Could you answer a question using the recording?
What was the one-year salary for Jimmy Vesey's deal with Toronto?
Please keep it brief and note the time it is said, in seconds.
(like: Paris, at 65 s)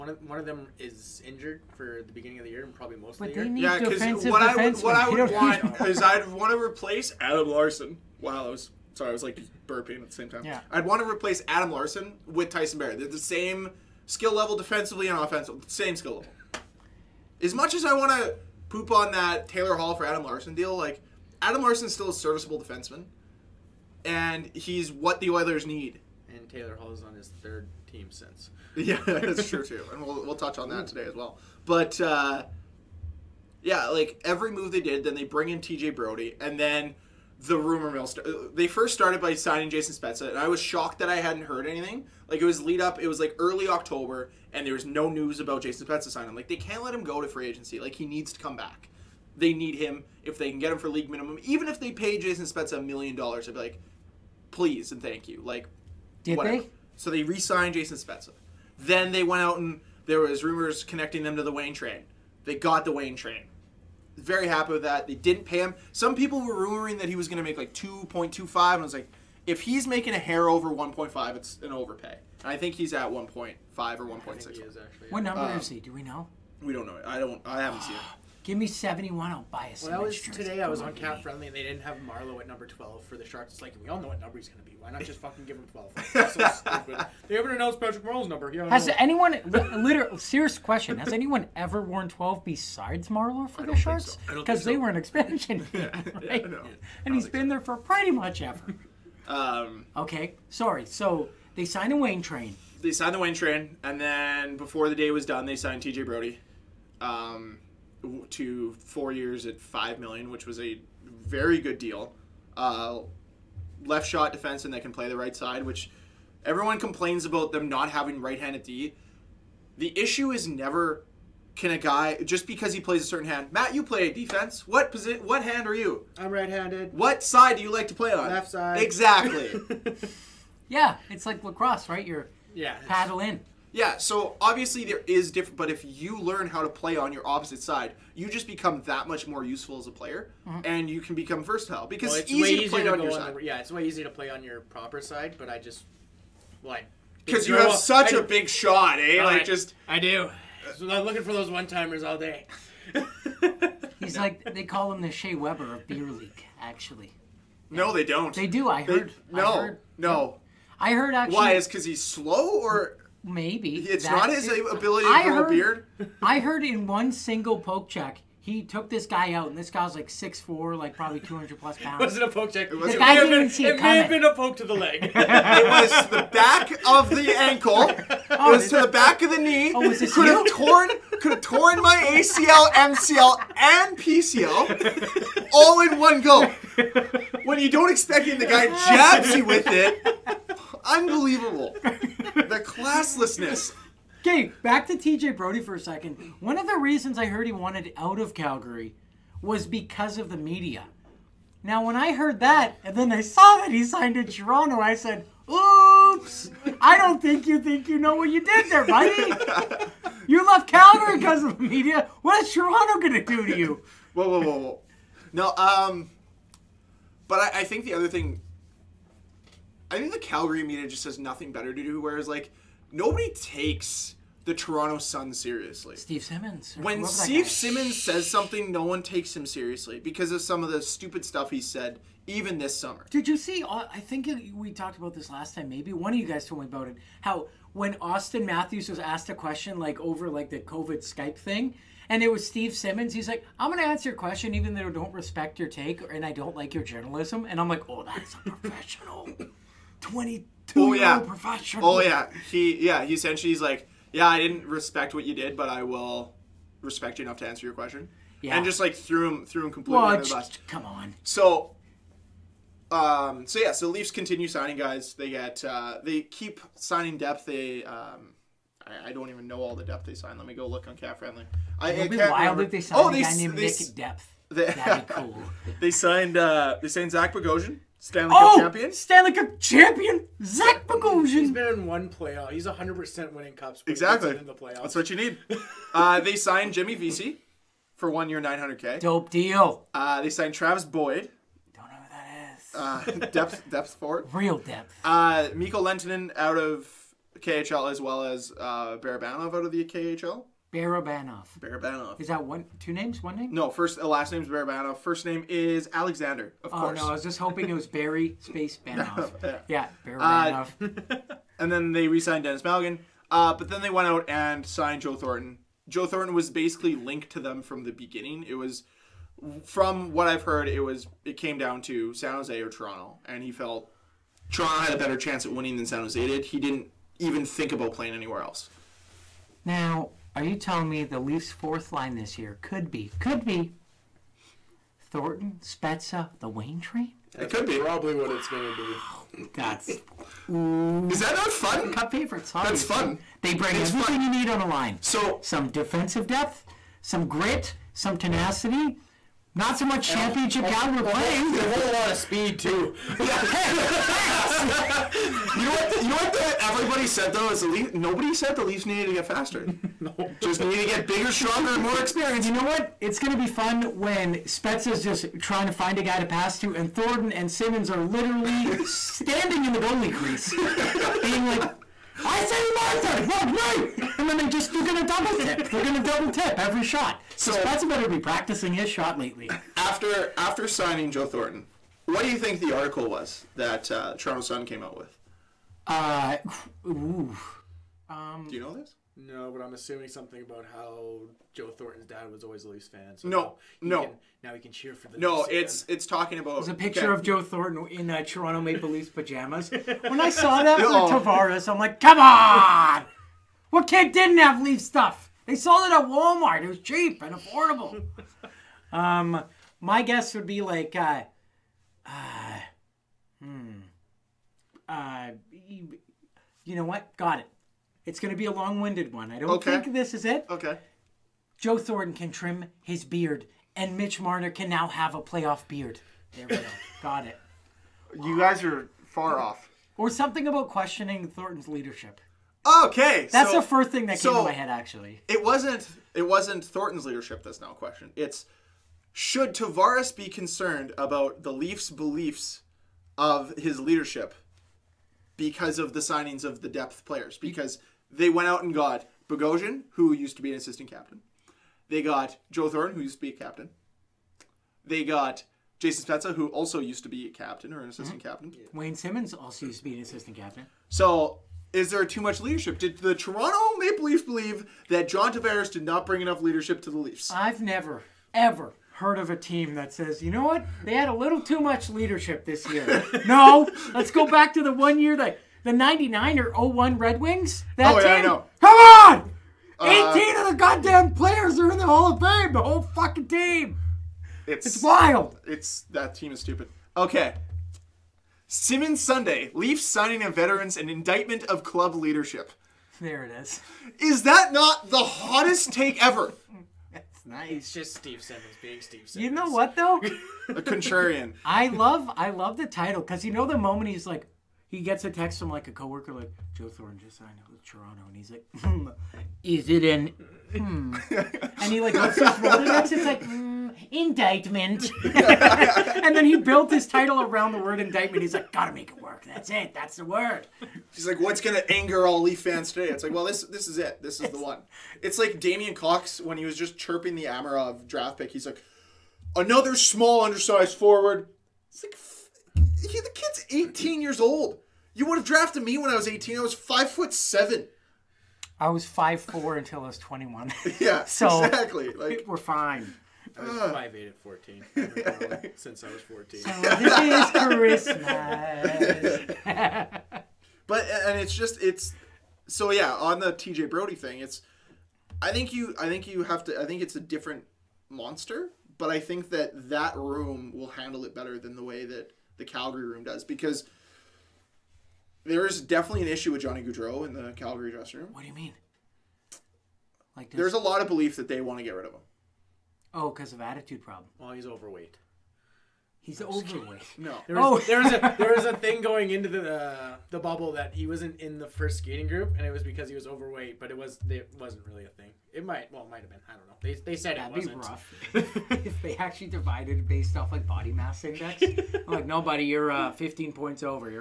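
900K, at 288 s.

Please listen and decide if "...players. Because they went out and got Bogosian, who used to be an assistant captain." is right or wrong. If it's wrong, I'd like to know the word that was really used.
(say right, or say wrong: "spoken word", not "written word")
right.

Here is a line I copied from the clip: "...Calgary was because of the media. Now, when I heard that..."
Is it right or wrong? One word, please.
right.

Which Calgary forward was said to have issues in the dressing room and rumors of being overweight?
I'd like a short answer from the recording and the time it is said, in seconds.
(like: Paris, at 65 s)
Johnny Gaudreau, at 566 s.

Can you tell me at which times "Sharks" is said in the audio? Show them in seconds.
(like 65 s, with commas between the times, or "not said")
83 s, 93 s.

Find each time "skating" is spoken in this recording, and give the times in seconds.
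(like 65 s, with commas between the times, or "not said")
581 s.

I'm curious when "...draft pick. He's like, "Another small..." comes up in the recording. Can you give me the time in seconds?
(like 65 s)
527 s.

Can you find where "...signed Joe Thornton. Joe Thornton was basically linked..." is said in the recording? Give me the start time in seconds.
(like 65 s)
314 s.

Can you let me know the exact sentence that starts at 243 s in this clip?
He's like, I'm going to answer your question even though I don't respect your take and I don't like your journalism.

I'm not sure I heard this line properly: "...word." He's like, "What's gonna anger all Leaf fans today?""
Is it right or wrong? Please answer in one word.
right.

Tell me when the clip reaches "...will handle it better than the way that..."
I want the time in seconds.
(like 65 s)
560 s.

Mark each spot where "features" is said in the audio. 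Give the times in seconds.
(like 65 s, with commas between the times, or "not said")
not said.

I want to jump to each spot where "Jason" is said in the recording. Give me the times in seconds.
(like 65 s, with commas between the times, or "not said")
39 s, 45 s, 52 s, 57 s, 455 s.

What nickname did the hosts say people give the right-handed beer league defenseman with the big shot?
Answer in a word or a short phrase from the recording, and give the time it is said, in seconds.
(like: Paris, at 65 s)
Shea Weber of beer league, at 155 s.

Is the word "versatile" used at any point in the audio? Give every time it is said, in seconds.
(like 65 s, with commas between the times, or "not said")
141 s.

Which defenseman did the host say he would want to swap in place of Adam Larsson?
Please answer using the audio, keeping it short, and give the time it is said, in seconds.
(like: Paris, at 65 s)
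Tyson Barrett, at 12 s.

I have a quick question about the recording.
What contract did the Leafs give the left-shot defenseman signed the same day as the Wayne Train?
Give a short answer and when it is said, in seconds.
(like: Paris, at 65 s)
4 years at 5 million, at 108 s.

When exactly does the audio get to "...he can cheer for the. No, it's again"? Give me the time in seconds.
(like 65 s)
394 s.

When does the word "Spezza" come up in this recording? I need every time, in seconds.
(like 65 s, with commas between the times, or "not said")
39 s, 45 s, 52 s, 57 s, 335 s, 364 s, 377 s, 456 s.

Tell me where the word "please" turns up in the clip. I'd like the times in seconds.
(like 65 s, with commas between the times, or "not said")
54 s.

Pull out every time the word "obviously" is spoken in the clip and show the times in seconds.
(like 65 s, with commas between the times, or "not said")
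134 s, 342 s.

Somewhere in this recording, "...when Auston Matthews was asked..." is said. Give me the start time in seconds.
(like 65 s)
237 s.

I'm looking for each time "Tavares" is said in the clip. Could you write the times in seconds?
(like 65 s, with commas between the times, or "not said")
401 s, 439 s, 465 s.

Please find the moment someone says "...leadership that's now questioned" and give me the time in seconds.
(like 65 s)
437 s.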